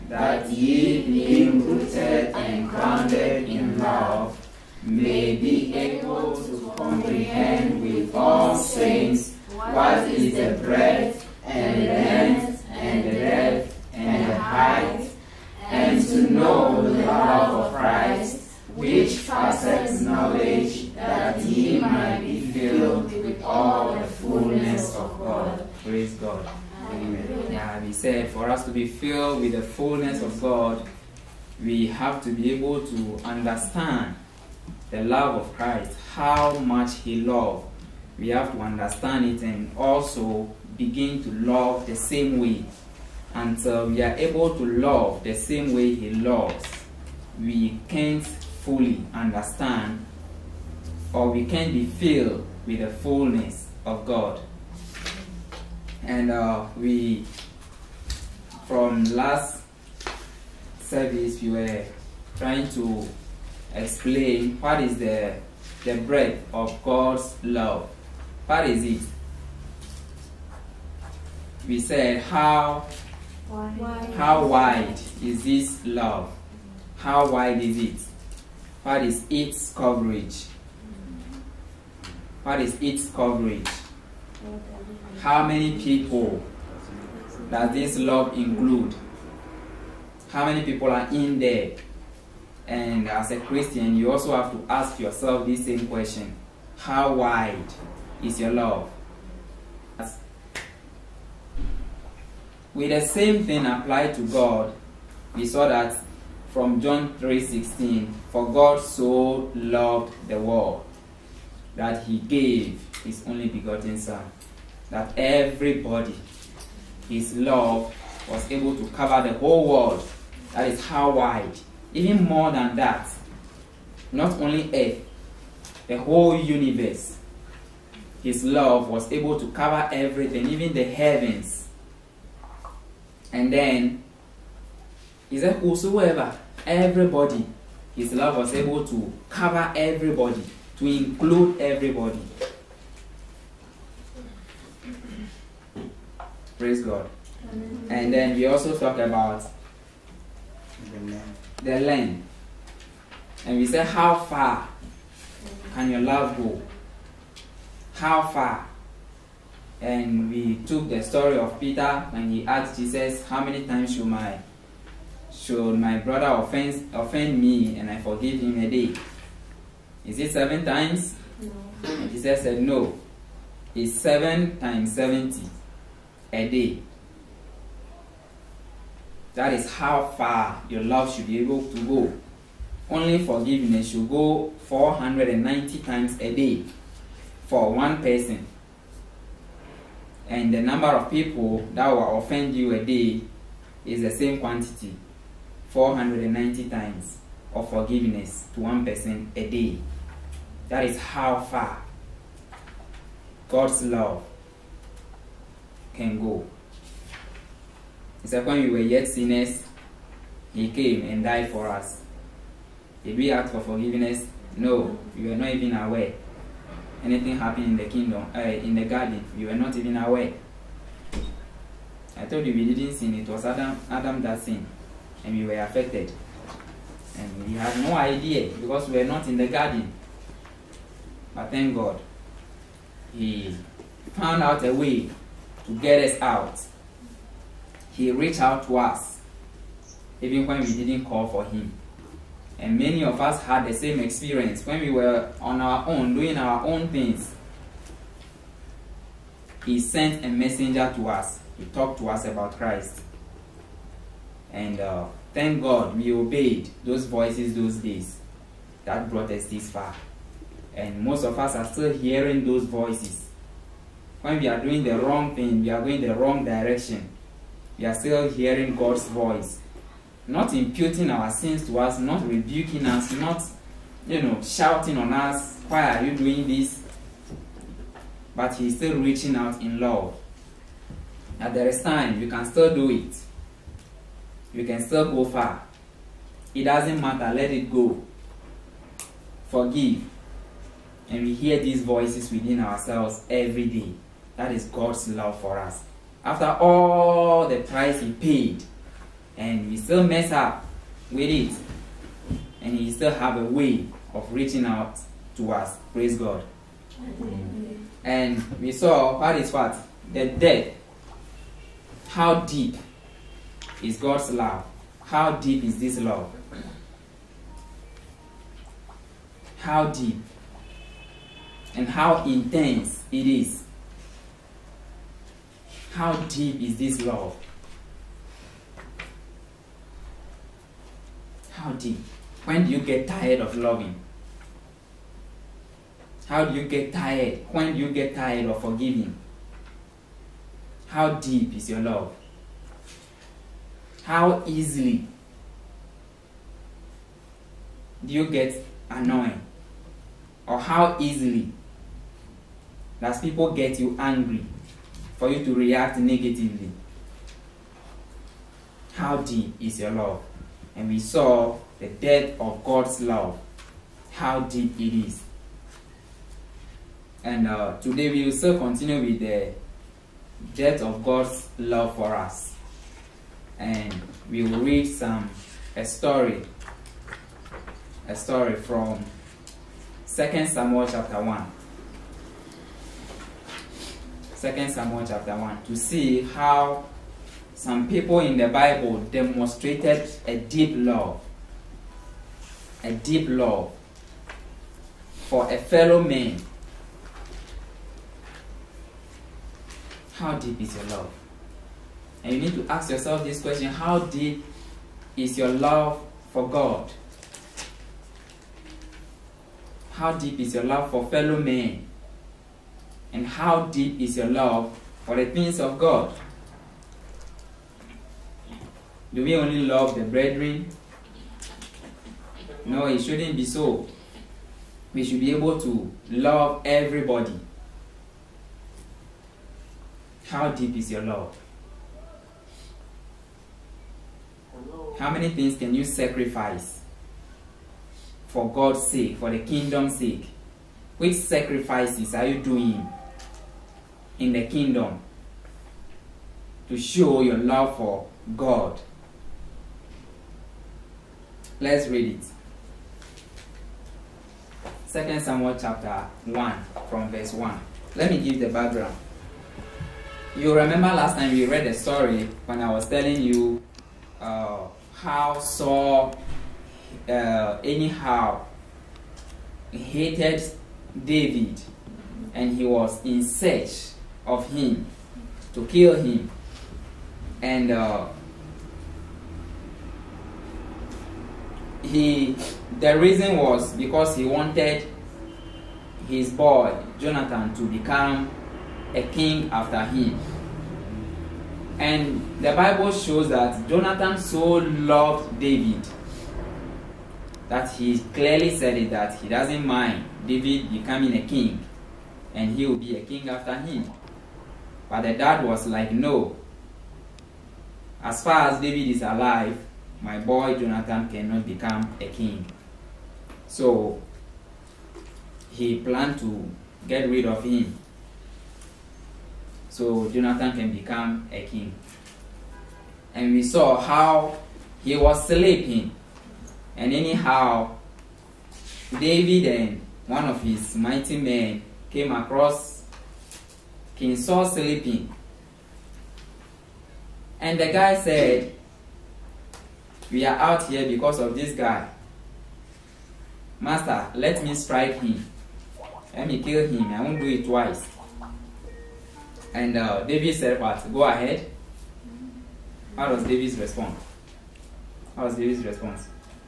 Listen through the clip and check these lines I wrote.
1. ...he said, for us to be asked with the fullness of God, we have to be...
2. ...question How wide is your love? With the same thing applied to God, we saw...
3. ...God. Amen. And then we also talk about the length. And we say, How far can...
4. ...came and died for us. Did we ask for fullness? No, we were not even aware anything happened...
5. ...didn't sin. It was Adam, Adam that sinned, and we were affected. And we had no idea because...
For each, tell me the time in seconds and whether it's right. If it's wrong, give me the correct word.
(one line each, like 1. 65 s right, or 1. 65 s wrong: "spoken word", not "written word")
1. 27 s wrong: "filled", not "asked"
2. 95 s right
3. 146 s right
4. 210 s wrong: "forgiveness", not "fullness"
5. 222 s right.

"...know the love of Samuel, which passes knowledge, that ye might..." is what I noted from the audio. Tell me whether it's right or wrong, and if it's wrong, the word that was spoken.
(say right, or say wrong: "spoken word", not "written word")
wrong: "Christ", not "Samuel".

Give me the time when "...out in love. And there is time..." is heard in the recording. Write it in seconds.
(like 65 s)
279 s.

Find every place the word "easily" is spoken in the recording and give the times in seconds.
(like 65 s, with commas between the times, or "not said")
344 s, 350 s.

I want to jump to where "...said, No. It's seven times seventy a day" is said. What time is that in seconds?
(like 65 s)
172 s.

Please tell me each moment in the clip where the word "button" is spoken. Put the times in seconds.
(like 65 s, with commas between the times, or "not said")
not said.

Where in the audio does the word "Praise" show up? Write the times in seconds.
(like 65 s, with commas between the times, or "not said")
25 s, 146 s, 305 s.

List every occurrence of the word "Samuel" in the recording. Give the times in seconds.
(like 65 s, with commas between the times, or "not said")
380 s, 384 s, 455 s.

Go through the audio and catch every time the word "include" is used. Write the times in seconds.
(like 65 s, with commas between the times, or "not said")
88 s, 140 s.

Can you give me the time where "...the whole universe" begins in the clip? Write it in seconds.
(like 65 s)
125 s.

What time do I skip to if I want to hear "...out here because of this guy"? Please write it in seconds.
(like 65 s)
540 s.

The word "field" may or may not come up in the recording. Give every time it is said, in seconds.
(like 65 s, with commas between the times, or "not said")
not said.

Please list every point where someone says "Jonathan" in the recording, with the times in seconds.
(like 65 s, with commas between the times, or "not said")
486 s, 493 s, 510 s, 520 s.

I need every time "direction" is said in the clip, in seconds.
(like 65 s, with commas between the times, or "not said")
266 s.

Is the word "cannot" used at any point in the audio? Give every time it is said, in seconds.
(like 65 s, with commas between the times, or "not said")
511 s.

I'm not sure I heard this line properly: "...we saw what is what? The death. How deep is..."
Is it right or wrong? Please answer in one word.
right.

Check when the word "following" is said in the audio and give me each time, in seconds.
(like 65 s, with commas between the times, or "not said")
not said.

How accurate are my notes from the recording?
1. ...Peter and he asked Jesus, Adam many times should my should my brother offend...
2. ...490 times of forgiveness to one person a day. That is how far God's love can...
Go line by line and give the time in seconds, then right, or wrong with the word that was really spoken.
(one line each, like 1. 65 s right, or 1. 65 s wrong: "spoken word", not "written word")
1. 161 s wrong: "How", not "Adam"
2. 195 s right.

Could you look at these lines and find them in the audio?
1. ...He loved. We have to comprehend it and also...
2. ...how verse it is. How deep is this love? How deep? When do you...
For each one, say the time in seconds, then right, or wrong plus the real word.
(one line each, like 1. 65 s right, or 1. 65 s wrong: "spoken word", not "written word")
1. 36 s wrong: "understand", not "comprehend"
2. 321 s wrong: "intense", not "verse".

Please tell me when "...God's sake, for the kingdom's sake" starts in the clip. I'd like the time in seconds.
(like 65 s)
438 s.